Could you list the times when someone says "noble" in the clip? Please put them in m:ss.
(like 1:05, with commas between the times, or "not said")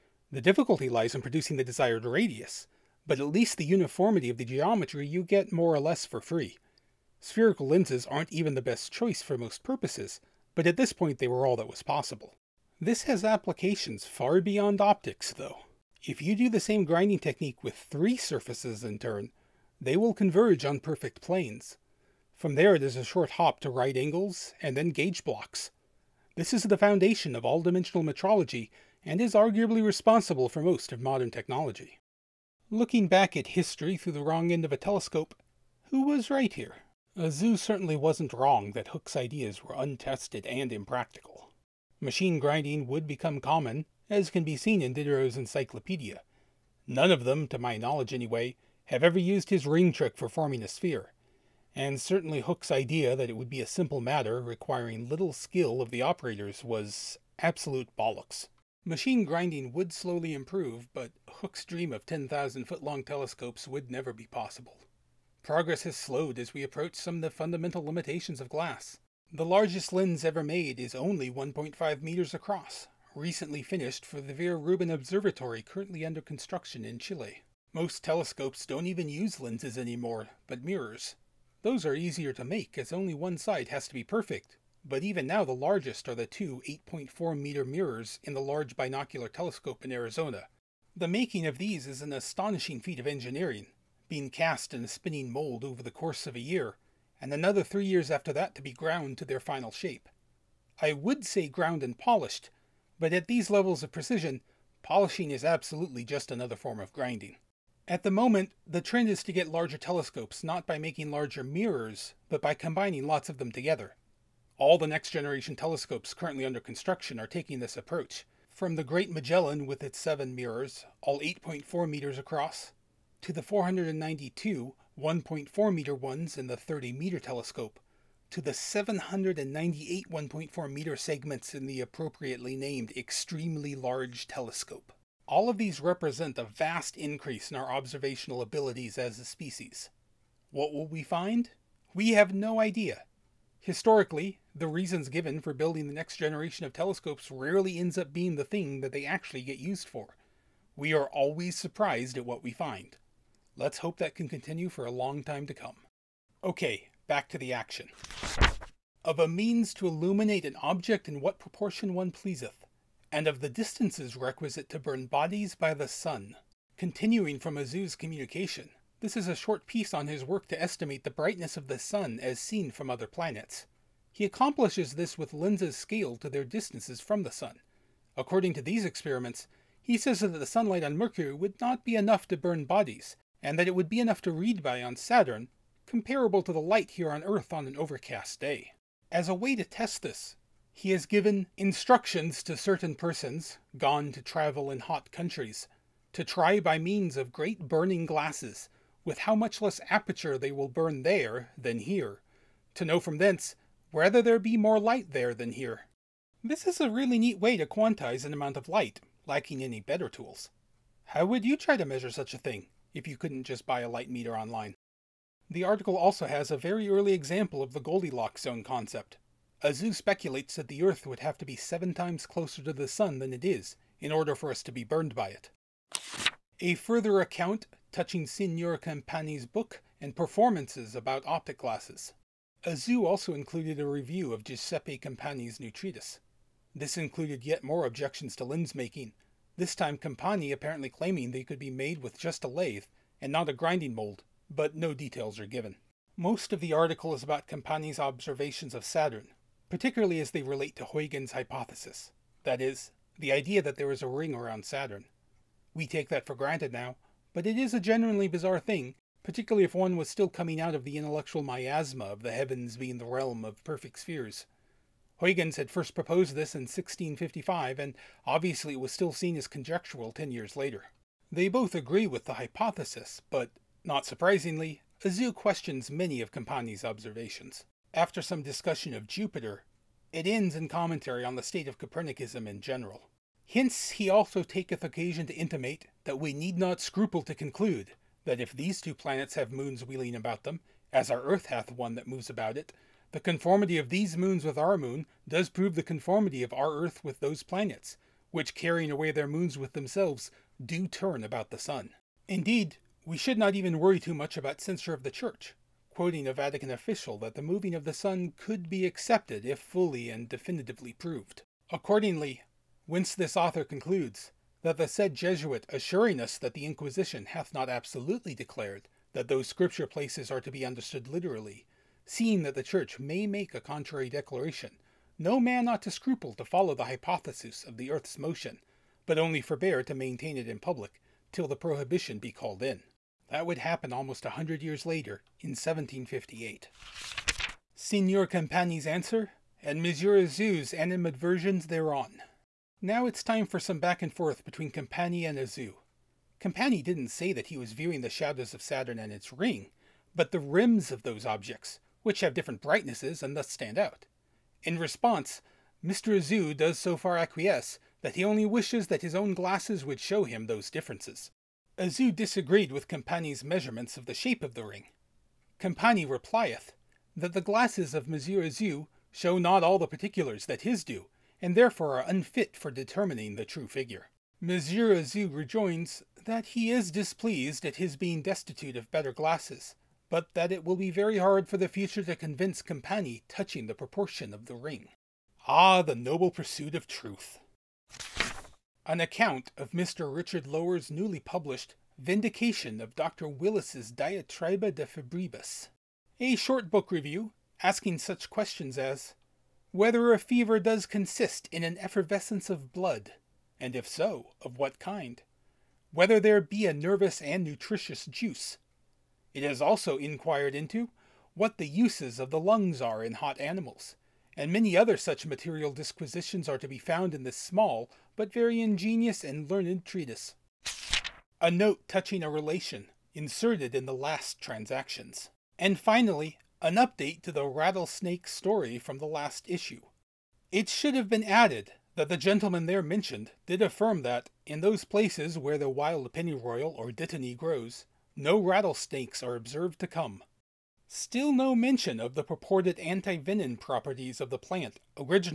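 6:25.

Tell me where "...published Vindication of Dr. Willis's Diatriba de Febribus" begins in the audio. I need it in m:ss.
6:31.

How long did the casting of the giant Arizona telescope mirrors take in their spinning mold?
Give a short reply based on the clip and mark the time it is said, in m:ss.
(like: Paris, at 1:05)
a year, at 1:35.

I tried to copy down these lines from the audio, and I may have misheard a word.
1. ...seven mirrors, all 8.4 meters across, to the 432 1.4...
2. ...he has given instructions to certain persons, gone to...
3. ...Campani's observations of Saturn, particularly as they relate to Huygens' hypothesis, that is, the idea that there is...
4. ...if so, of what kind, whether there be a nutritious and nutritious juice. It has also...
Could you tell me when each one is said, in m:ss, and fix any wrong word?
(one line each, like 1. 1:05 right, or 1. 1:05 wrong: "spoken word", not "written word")
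1. 1:59 wrong: "492", not "432"
2. 3:10 right
3. 4:07 right
4. 6:43 wrong: "nervous", not "nutritious".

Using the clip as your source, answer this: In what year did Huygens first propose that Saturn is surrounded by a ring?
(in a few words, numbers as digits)
1655.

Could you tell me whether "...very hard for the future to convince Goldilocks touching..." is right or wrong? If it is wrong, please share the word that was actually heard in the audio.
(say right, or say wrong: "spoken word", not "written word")
wrong: "Campani", not "Goldilocks".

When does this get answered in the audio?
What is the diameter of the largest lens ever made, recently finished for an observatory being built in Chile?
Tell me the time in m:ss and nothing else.
1:11.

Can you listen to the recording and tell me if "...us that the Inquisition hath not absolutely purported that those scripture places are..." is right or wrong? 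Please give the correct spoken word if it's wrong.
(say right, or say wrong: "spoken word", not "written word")
wrong: "declared", not "purported".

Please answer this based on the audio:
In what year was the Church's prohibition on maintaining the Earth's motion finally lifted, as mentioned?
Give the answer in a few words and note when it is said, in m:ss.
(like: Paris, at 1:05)
1758, at 5:35.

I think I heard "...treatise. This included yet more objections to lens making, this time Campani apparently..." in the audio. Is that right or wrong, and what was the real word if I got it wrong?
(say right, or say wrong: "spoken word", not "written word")
right.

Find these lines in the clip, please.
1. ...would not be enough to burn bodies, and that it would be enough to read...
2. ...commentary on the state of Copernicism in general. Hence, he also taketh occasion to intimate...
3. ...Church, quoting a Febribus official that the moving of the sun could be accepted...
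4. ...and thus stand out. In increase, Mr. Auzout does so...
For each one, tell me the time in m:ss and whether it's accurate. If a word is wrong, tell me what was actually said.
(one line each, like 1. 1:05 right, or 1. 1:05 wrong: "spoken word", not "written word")
1. 3:01 right
2. 4:40 right
3. 5:05 wrong: "Vatican", not "Febribus"
4. 5:53 wrong: "response", not "increase".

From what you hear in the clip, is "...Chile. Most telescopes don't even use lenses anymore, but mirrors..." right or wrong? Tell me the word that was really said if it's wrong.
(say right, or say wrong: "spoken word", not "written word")
right.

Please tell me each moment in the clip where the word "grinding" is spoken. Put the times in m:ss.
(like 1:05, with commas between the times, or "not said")
0:16, 0:42, 0:59, 1:46, 4:03.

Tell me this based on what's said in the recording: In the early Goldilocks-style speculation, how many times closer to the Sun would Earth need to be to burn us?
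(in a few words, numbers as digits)
7.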